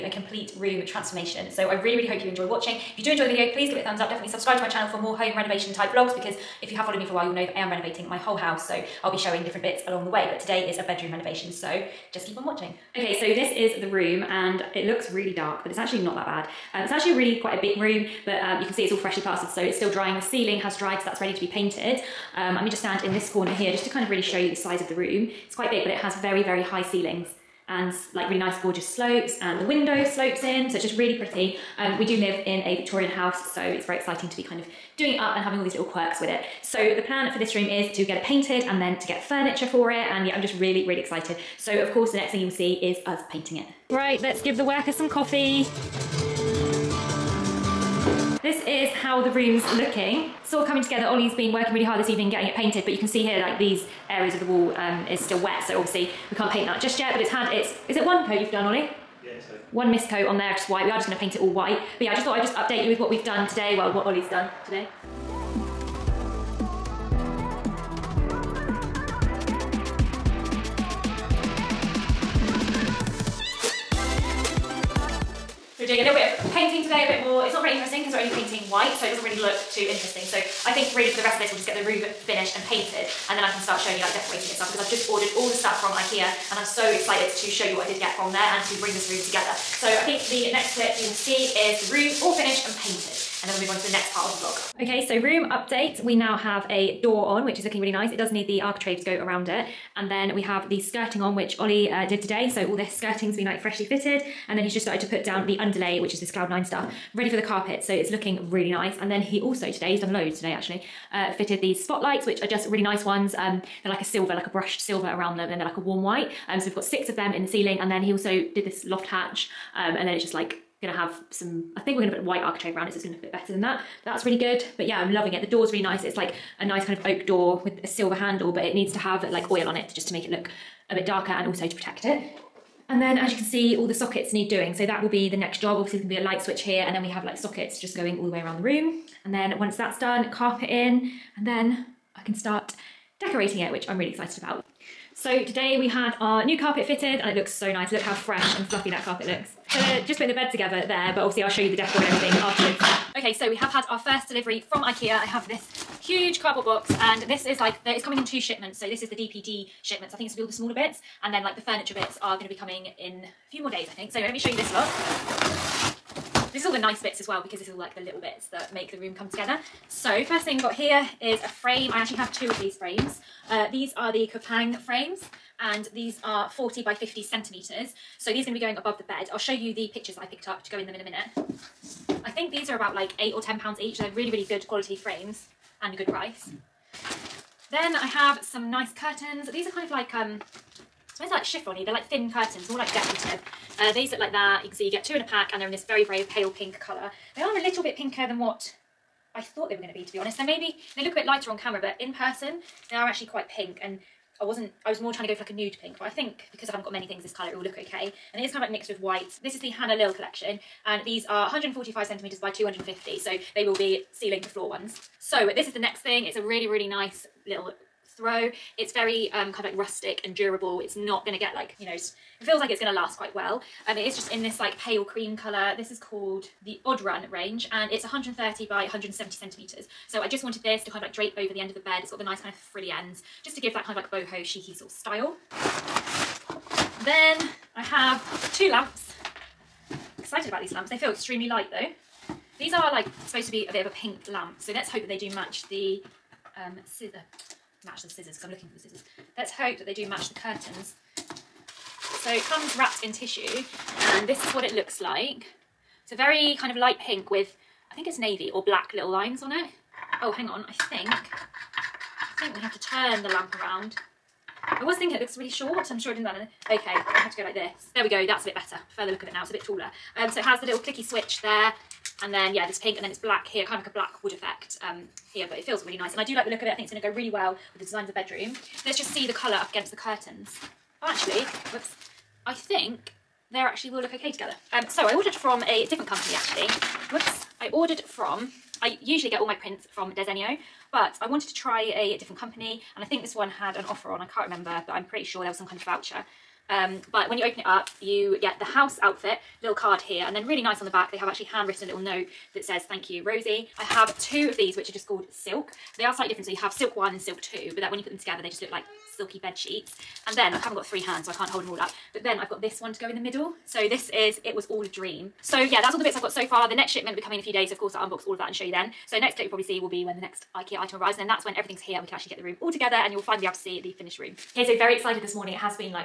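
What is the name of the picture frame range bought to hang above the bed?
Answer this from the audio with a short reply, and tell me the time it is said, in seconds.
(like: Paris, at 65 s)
Knoppäng, at 174 s.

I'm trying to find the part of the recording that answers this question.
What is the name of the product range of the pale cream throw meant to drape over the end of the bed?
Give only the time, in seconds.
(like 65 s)
226 s.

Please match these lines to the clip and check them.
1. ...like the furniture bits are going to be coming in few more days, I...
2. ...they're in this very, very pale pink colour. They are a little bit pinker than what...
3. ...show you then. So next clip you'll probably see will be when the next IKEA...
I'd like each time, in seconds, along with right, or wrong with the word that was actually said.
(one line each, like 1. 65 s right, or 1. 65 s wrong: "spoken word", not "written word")
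1. 161 s right
2. 195 s right
3. 318 s right.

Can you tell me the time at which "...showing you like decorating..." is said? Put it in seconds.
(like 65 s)
83 s.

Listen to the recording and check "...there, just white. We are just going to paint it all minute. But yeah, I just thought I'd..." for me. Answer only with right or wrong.
wrong.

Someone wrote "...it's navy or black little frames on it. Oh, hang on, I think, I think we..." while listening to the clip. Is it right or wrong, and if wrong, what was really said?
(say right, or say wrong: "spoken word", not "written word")
wrong: "lines", not "frames".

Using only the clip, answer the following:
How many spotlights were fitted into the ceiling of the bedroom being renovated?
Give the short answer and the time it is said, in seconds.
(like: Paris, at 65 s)
6, at 116 s.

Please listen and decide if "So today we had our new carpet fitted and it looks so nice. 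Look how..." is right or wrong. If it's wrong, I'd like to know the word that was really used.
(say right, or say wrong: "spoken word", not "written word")
right.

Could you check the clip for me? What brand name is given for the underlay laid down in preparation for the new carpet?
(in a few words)
Cloud Nine.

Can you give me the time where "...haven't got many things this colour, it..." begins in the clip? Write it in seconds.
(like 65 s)
206 s.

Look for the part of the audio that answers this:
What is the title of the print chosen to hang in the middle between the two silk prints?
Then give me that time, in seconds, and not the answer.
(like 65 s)
314 s.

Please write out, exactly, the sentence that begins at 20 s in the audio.
The ceiling has dried, so that's ready to be painted.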